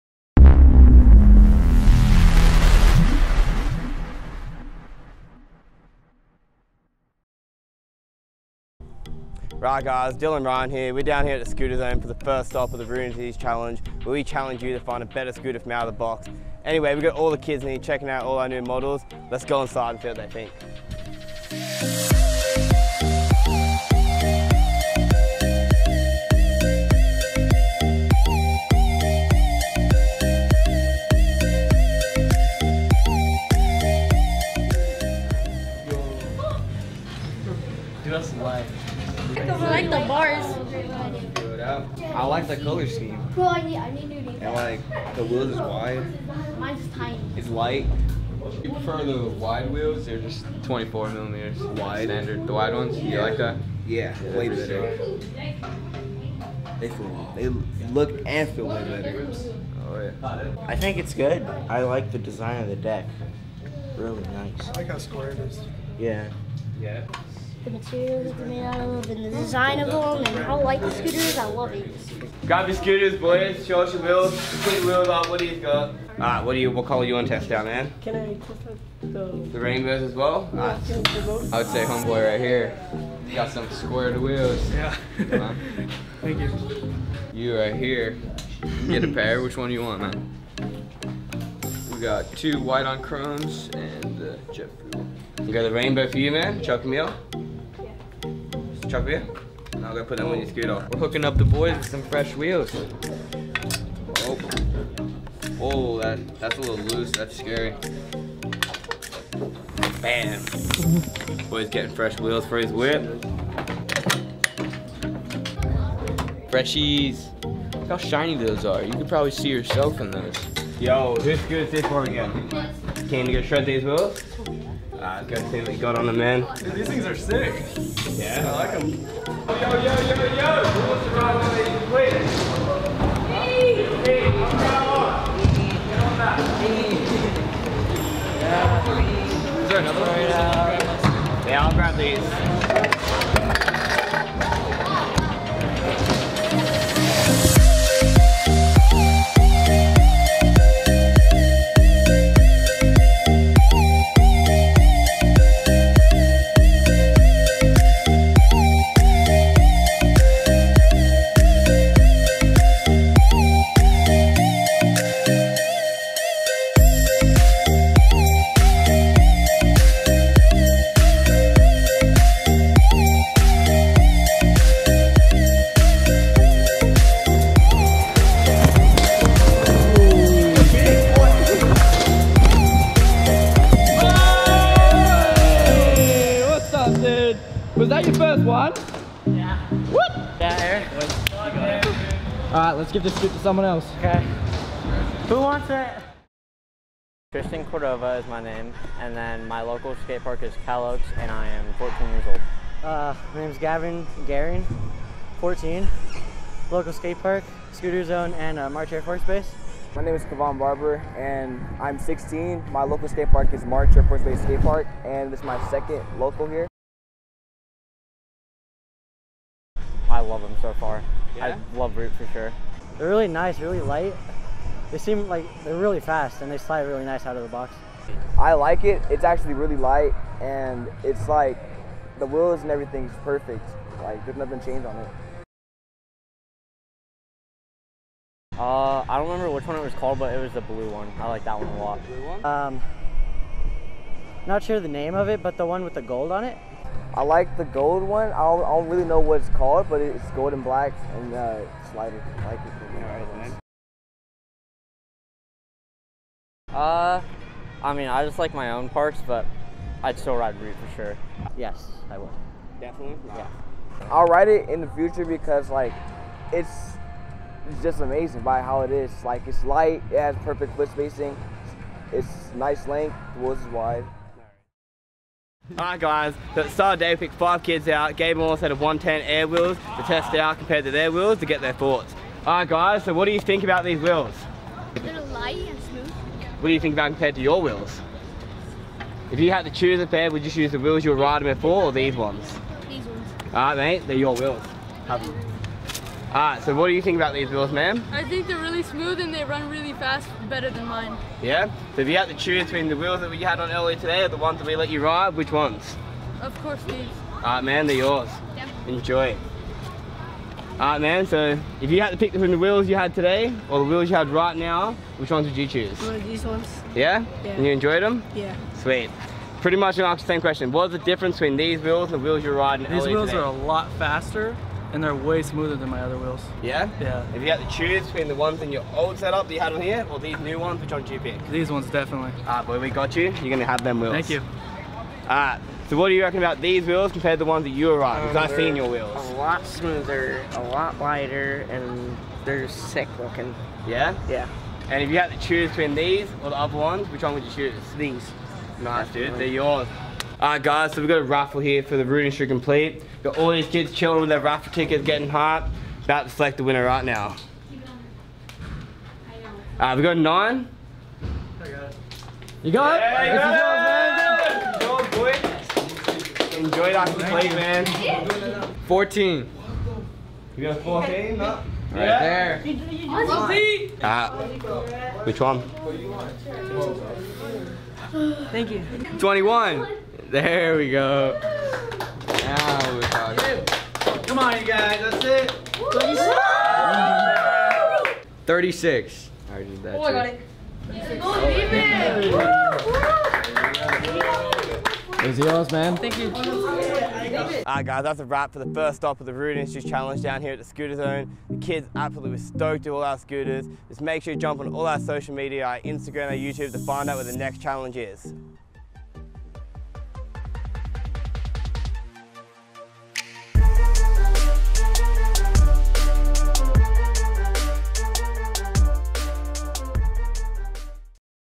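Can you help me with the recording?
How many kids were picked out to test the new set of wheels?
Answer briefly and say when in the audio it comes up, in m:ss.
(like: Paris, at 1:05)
5, at 4:37.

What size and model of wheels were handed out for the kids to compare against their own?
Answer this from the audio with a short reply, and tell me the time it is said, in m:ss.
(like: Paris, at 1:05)
110 Air, at 4:38.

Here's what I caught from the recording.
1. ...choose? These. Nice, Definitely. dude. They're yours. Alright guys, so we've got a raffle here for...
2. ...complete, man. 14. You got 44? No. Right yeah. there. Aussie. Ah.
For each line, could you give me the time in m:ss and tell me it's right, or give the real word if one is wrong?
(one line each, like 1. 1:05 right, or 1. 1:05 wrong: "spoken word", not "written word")
1. 5:47 right
2. 6:07 wrong: "14", not "44".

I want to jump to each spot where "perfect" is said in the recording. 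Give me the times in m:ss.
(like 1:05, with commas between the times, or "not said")
3:53, 4:30.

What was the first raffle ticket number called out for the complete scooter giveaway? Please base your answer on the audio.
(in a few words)
9.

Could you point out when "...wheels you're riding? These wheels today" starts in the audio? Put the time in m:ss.
5:22.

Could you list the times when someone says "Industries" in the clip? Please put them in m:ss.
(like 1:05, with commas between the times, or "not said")
0:13, 5:52, 6:39.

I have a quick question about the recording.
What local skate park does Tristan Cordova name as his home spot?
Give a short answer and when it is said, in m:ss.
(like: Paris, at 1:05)
Cal Oaks, at 3:20.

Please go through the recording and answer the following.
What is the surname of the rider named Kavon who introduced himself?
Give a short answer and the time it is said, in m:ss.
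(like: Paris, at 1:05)
Barber, at 3:30.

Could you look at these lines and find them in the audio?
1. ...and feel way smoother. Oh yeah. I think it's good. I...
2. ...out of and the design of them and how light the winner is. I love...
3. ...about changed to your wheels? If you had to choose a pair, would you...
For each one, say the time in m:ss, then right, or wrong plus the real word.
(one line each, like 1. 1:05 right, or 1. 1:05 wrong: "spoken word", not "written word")
1. 0:58 wrong: "better", not "smoother"
2. 1:08 wrong: "scooter", not "winner"
3. 4:46 wrong: "compared", not "changed".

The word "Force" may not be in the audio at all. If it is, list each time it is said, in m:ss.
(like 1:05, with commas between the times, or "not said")
3:29, 3:34.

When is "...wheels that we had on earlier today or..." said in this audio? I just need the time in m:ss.
5:02.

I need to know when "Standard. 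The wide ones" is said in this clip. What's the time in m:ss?
0:52.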